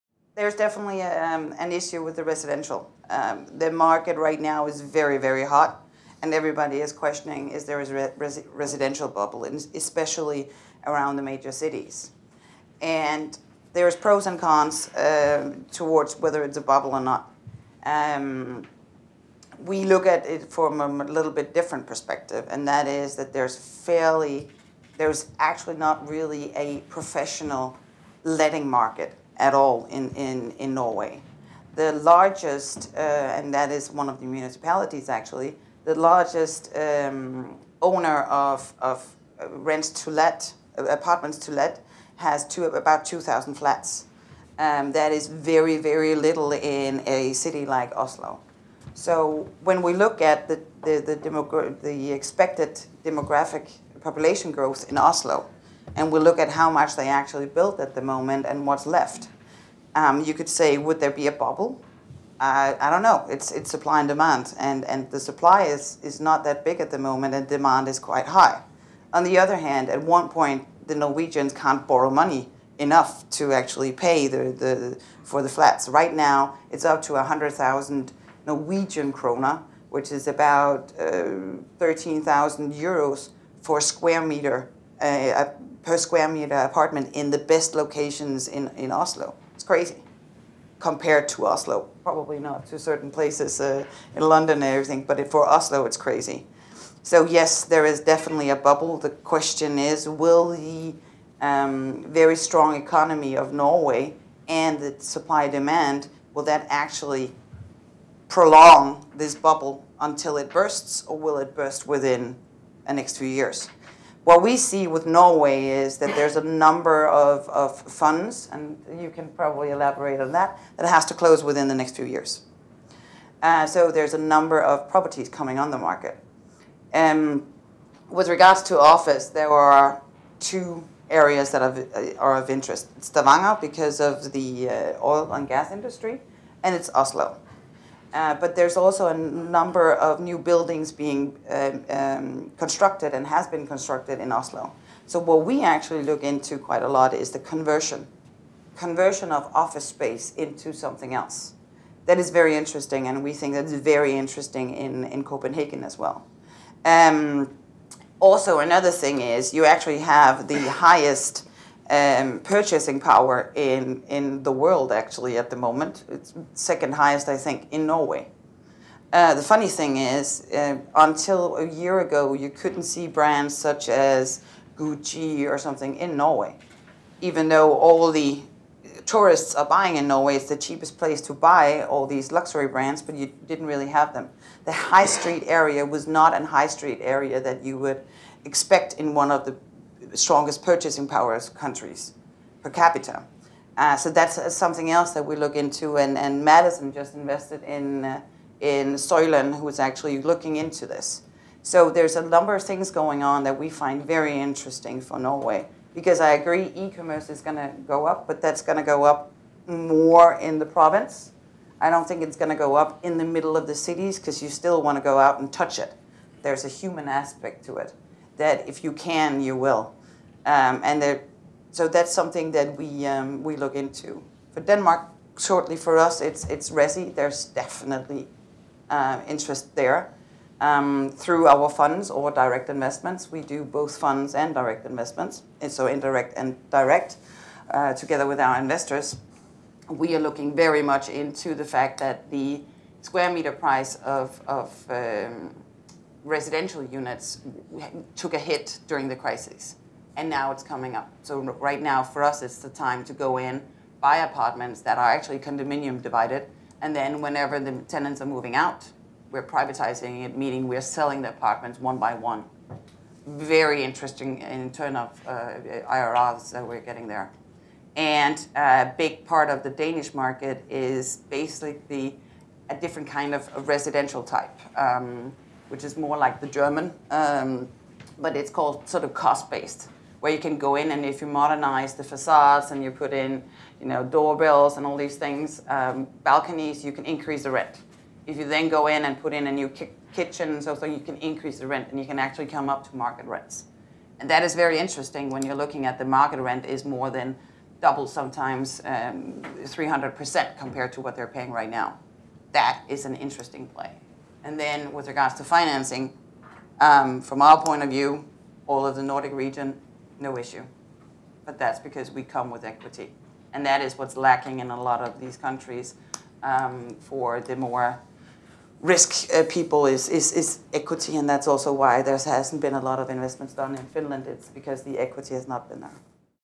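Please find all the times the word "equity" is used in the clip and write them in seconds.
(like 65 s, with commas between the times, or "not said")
312 s, 320 s, 324 s.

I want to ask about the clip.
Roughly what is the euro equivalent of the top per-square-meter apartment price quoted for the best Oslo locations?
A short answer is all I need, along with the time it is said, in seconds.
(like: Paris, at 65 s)
13,000 euros, at 81 s.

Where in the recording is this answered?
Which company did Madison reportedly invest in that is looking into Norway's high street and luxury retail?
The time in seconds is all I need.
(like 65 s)
198 s.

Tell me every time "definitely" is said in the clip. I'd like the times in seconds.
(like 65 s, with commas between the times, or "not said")
0 s, 97 s, 227 s.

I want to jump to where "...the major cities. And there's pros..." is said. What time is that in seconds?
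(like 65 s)
11 s.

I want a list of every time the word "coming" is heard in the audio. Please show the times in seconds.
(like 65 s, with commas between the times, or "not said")
125 s, 250 s.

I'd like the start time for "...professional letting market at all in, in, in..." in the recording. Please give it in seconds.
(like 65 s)
26 s.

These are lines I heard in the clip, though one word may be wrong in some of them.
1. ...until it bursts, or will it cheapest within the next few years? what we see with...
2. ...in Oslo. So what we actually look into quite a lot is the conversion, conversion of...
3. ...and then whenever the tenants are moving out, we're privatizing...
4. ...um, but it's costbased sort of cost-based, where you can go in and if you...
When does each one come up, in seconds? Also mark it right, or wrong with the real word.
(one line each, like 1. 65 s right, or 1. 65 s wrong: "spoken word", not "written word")
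1. 109 s wrong: "burst", not "cheapest"
2. 144 s right
3. 256 s right
4. 277 s wrong: "called", not "costbased".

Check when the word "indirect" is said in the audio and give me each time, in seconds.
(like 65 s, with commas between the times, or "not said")
235 s.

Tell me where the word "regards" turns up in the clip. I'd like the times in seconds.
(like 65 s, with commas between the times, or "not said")
128 s, 305 s.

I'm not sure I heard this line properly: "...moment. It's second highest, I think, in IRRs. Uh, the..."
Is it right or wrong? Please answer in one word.
wrong.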